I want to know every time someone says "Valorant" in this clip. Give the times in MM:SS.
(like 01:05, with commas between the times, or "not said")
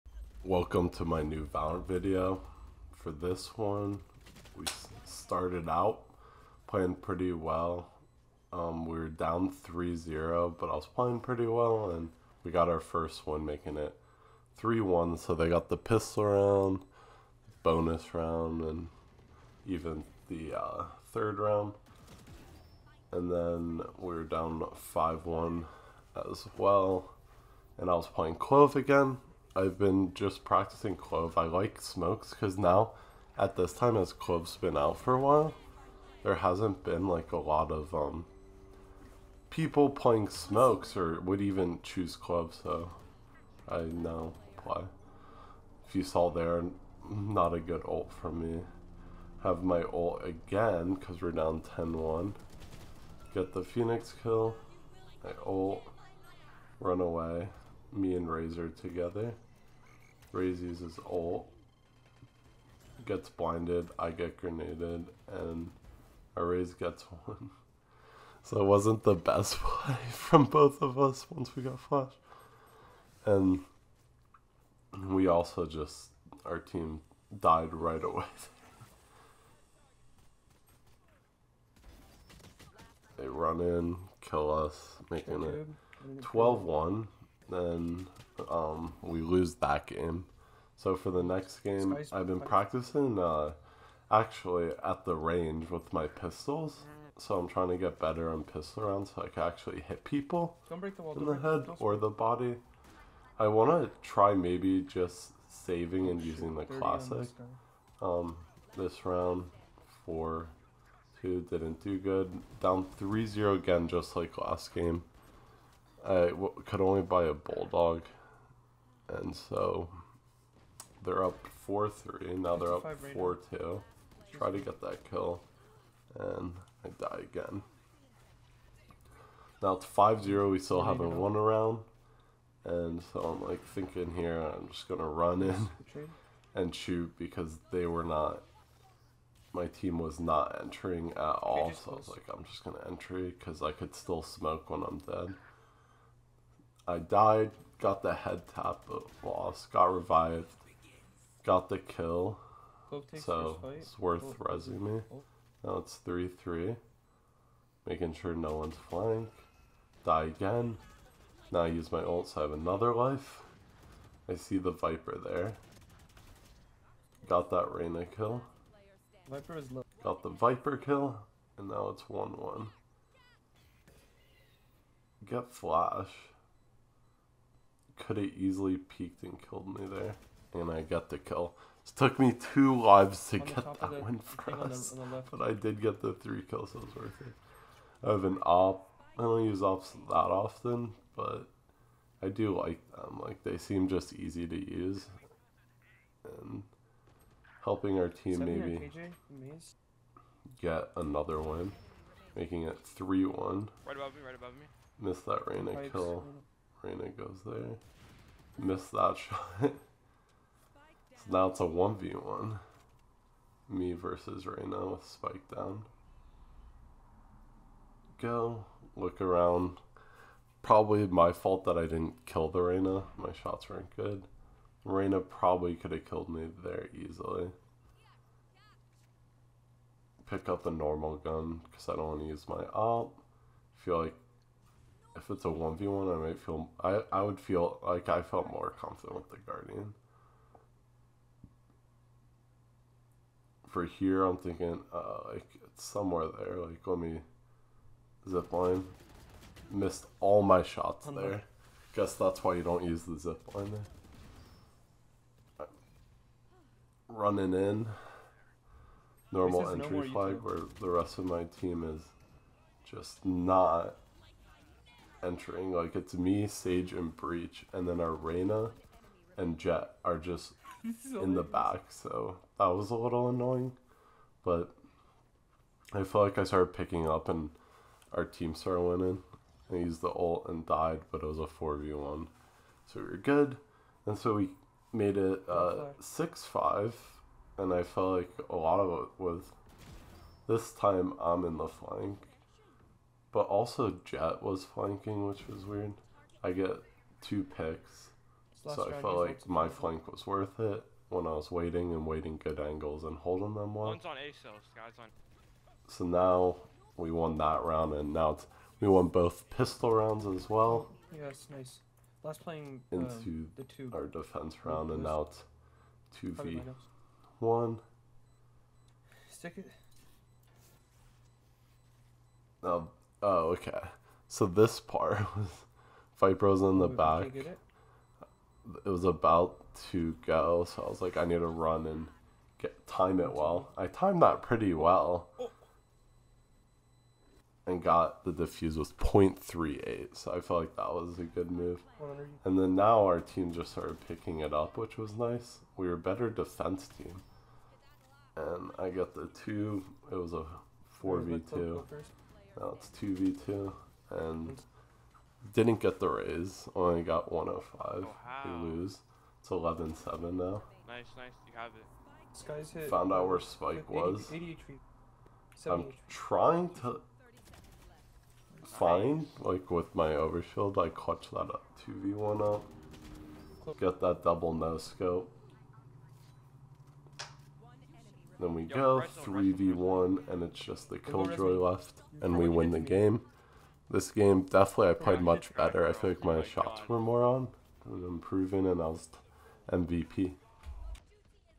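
00:01.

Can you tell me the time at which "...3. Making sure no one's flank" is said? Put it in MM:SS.
02:36.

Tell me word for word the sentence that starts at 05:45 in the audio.
We were a better defense team.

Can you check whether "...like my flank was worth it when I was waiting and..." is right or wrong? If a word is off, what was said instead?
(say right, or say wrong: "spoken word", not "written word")
right.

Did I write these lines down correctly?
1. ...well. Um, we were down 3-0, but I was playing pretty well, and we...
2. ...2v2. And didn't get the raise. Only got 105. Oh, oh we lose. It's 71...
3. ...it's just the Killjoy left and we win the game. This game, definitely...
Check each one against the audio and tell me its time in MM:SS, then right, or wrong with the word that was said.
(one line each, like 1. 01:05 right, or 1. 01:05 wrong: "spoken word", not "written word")
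1. 00:07 right
2. 05:52 wrong: "11", not "71"
3. 06:20 right.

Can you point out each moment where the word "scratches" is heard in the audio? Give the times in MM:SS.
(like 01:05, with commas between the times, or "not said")
not said.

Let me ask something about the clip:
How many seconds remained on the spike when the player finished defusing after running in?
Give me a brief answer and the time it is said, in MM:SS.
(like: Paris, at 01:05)
0.38, at 05:38.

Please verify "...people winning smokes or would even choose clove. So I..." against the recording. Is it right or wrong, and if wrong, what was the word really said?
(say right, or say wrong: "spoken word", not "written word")
wrong: "playing", not "winning".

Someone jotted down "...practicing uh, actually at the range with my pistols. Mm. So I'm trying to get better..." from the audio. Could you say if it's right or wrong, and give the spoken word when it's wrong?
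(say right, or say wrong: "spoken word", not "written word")
right.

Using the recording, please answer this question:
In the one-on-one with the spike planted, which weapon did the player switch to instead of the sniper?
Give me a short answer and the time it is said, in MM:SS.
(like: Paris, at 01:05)
Guardian, at 03:59.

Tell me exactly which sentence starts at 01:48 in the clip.
Um, this round, 4 2, didn't do good.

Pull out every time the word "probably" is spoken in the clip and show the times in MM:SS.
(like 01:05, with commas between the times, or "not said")
03:40, 03:45.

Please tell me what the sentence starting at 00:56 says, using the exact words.
Run away me and Razor together.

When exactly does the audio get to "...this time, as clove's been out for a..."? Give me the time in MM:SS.
00:33.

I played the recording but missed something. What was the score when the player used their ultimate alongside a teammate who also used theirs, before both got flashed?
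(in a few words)
10-1.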